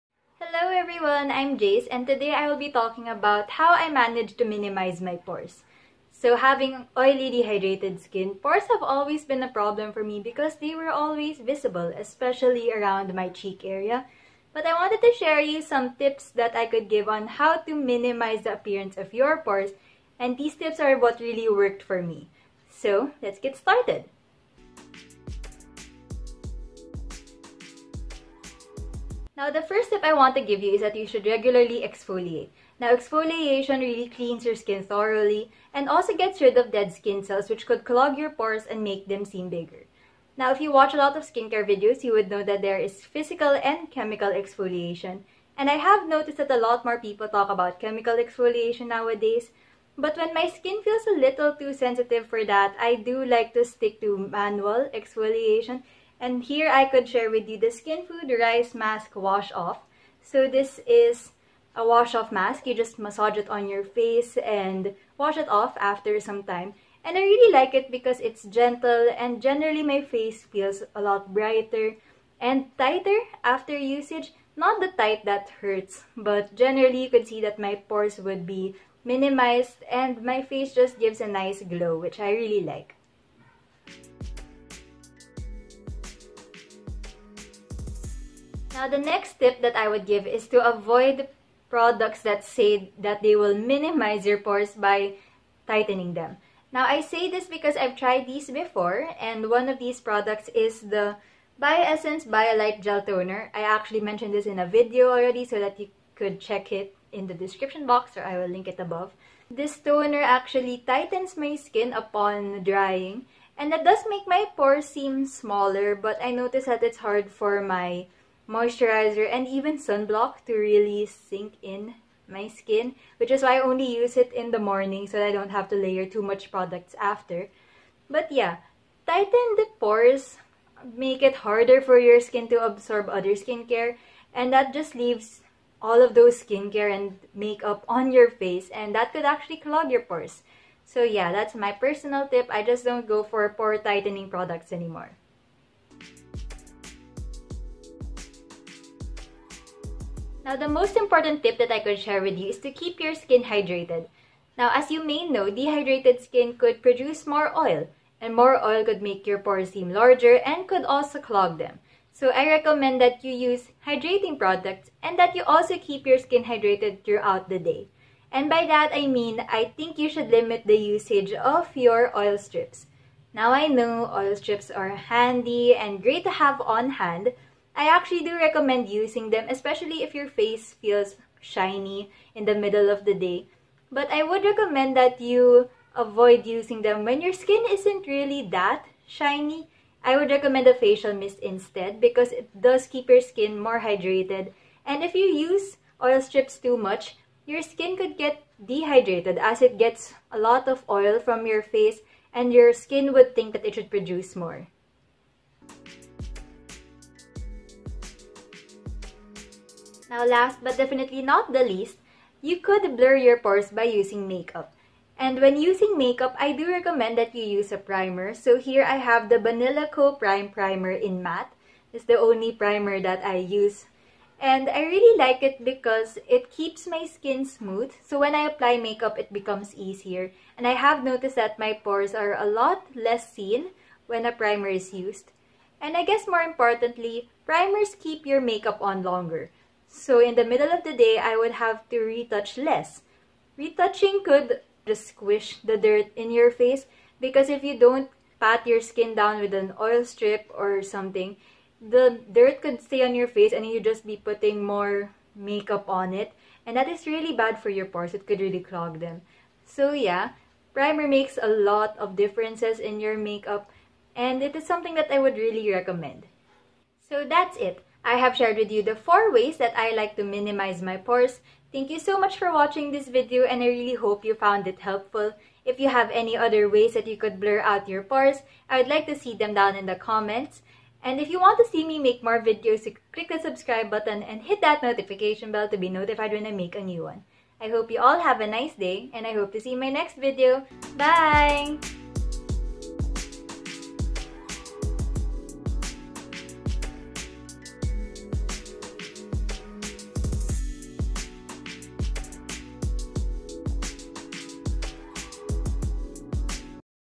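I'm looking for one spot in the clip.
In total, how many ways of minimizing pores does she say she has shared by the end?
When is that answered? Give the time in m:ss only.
4:28.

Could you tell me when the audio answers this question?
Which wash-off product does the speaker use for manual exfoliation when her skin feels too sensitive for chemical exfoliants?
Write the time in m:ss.
0:57.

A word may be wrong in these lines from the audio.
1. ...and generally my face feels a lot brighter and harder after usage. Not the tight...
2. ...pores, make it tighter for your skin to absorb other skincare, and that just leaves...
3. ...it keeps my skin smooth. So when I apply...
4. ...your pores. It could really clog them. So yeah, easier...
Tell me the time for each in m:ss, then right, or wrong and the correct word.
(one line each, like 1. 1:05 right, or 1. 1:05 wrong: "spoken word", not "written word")
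1. 1:09 wrong: "tighter", not "harder"
2. 2:09 wrong: "harder", not "tighter"
3. 3:46 right
4. 4:17 wrong: "primer", not "easier".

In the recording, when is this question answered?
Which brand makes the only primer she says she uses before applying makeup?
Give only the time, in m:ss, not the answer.
3:39.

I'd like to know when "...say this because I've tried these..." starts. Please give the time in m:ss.
1:37.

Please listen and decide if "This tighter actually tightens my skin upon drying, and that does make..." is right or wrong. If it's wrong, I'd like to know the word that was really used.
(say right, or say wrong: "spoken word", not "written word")
wrong: "toner", not "tighter".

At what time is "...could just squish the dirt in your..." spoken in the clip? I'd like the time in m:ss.
4:04.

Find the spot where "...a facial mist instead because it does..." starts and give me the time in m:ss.
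3:10.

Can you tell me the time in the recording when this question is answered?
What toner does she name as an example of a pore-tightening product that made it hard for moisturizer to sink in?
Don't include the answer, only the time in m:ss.
1:41.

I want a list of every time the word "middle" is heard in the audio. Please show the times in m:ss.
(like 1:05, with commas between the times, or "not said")
3:02, 4:00.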